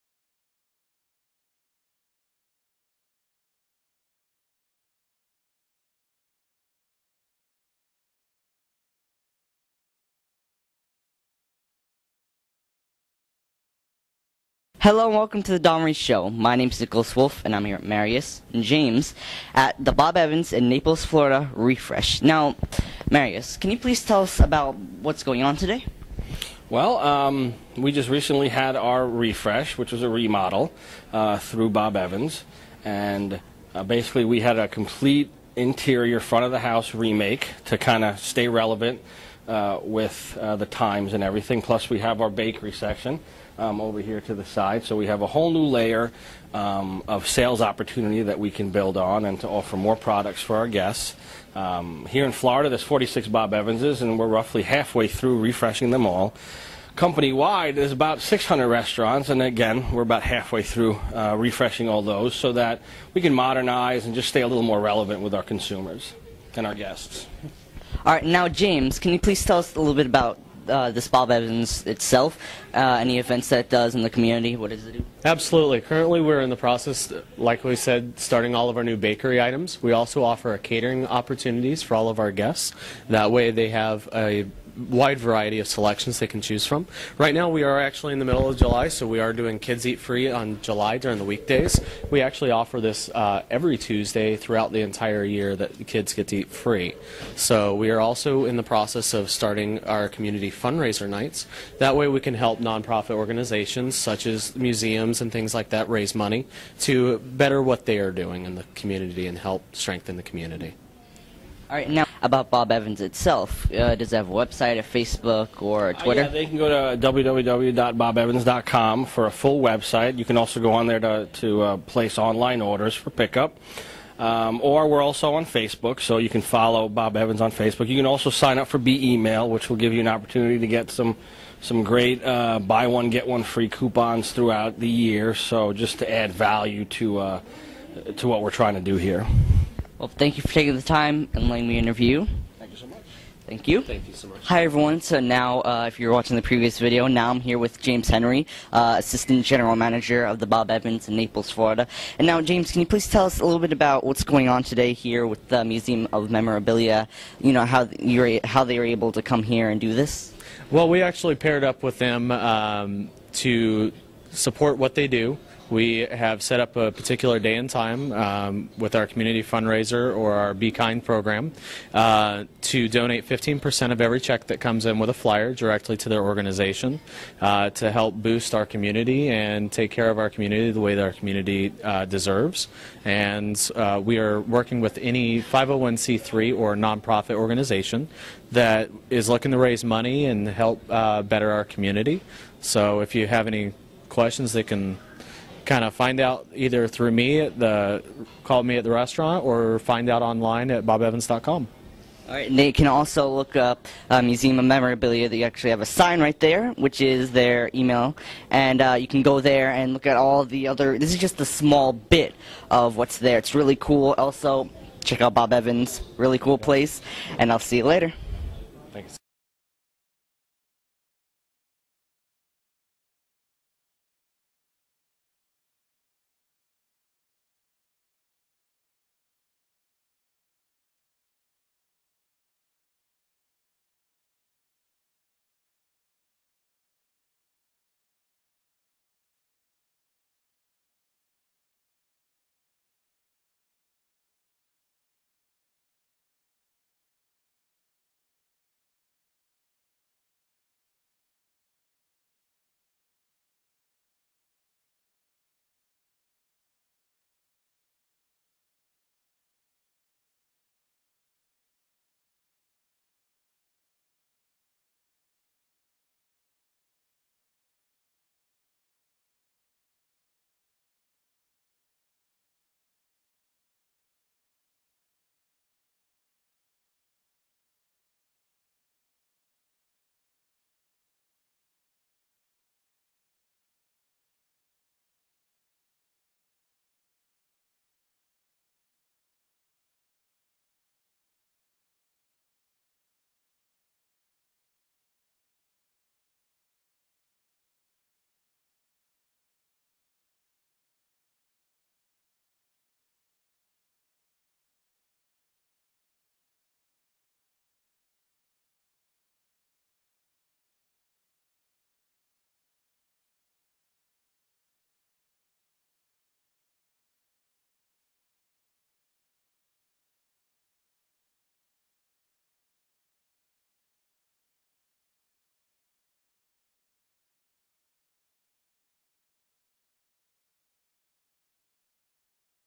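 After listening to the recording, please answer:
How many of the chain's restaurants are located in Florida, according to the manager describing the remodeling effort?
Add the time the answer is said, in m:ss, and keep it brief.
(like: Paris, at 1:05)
46, at 0:52.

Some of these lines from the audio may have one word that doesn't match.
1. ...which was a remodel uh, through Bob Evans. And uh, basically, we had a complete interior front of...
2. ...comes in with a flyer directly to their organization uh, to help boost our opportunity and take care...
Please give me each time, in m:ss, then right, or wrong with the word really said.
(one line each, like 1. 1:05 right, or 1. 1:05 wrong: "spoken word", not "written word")
1. 0:29 right
2. 2:54 wrong: "community", not "opportunity".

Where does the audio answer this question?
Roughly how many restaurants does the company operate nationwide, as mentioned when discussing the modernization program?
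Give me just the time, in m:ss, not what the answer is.
0:58.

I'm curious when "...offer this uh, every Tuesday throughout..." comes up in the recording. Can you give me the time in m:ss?
1:32.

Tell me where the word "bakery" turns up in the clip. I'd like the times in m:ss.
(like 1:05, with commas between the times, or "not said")
0:42, 1:18.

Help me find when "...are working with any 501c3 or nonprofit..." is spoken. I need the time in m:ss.
3:04.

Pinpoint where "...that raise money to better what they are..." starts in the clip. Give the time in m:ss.
1:45.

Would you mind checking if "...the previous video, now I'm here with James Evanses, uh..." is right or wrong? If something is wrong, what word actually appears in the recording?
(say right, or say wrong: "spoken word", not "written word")
wrong: "Henry", not "Evanses".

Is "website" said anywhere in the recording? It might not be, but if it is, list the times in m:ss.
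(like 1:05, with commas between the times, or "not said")
1:54, 1:59.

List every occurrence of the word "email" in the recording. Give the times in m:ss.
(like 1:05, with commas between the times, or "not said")
2:09, 3:27.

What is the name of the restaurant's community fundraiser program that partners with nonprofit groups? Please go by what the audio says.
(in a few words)
Be Kind.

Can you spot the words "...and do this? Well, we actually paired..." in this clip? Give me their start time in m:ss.
2:39.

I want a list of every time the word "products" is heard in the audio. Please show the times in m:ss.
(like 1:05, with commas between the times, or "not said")
0:49.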